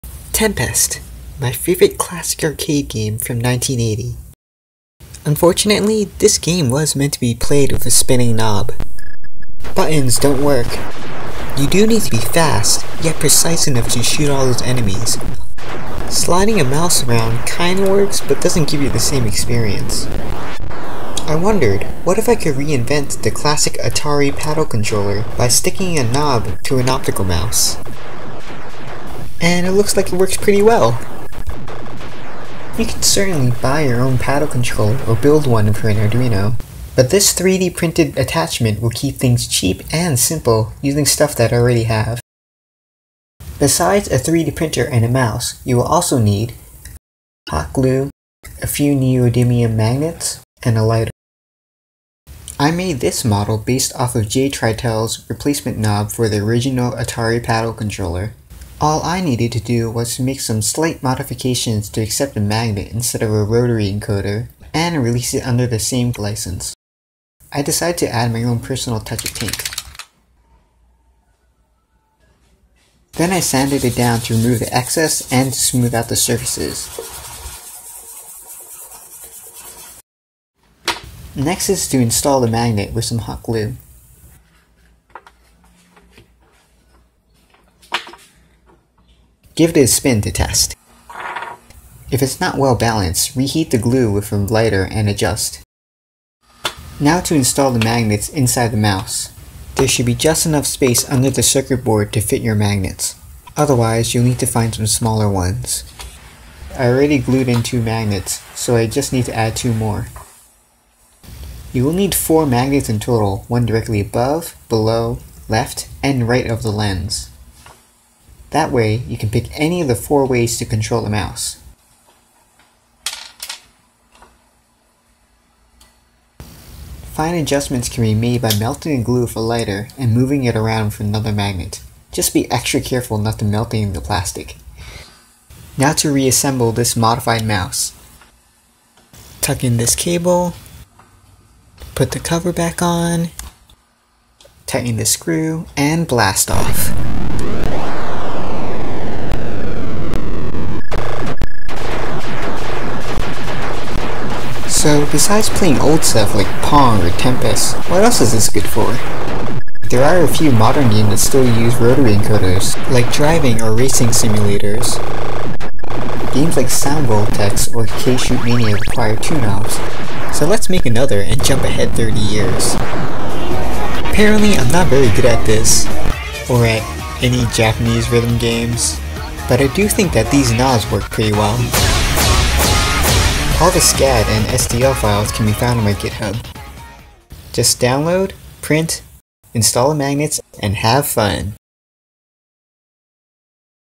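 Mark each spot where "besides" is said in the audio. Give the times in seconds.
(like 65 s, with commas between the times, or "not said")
43 s, 155 s.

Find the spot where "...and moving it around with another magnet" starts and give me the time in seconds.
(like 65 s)
129 s.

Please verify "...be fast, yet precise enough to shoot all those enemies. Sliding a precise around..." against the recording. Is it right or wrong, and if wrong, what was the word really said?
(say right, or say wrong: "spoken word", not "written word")
wrong: "mouse", not "precise".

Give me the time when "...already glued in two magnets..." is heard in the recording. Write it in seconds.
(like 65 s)
106 s.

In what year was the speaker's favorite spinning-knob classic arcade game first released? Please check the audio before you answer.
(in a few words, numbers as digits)
1980.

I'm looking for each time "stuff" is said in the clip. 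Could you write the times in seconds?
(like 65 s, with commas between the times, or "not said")
41 s, 156 s.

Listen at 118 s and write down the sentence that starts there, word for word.
That way, you can pick any of the four ways to control the mouse.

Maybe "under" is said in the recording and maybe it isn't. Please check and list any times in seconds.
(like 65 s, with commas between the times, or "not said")
65 s, 101 s.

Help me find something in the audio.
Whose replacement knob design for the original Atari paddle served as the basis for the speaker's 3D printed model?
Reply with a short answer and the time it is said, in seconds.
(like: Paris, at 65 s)
J Tritell, at 54 s.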